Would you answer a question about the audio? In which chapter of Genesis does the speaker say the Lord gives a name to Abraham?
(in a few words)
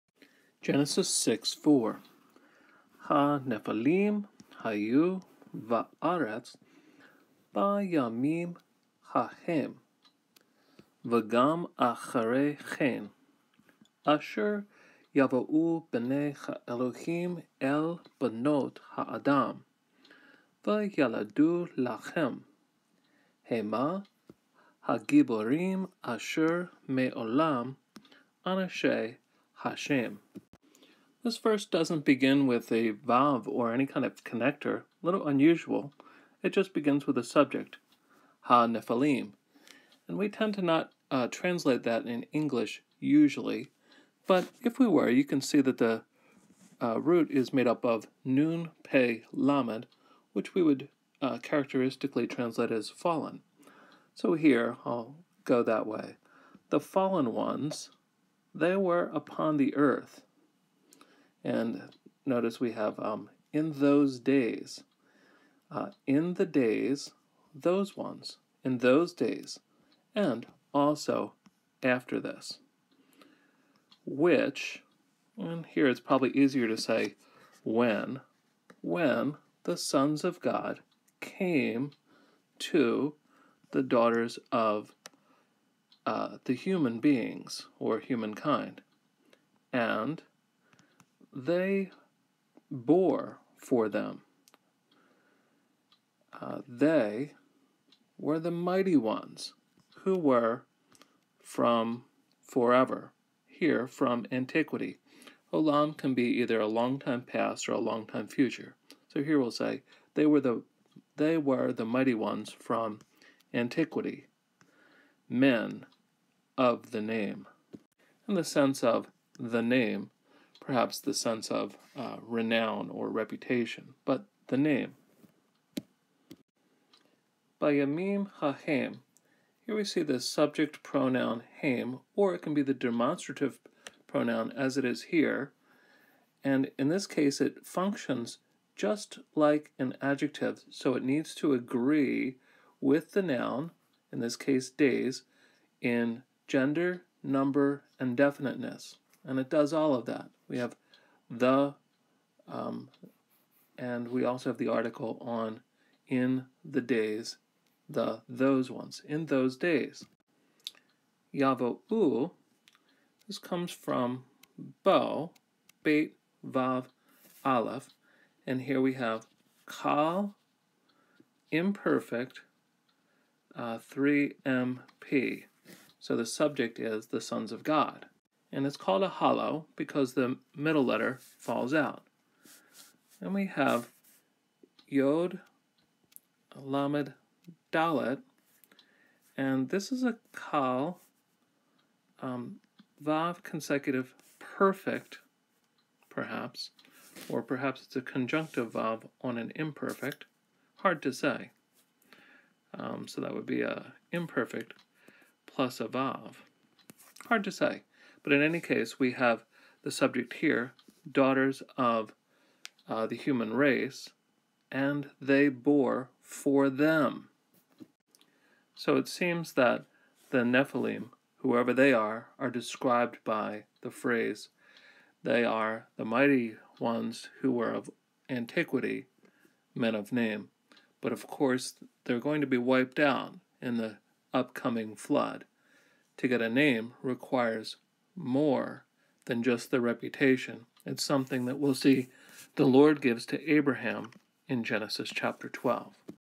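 12.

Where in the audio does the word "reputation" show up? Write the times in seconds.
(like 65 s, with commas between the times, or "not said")
123 s, 239 s.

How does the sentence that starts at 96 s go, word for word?
Uh, they were the mighty ones who were from forever, here from antiquity.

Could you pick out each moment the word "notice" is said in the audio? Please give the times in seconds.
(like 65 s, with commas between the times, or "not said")
62 s.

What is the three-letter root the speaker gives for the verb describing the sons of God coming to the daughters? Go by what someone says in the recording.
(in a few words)
bo.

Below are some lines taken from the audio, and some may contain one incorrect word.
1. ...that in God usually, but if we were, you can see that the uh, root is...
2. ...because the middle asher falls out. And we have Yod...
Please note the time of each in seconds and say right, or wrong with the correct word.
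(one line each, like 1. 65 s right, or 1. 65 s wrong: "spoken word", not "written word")
1. 41 s wrong: "English", not "God"
2. 179 s wrong: "letter", not "asher".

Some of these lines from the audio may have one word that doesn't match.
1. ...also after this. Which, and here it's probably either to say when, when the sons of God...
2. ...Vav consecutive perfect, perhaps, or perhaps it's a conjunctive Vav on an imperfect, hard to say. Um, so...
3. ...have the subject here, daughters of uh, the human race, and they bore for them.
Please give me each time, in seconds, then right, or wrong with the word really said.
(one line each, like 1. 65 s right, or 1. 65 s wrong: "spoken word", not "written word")
1. 70 s wrong: "easier", not "either"
2. 193 s right
3. 209 s right.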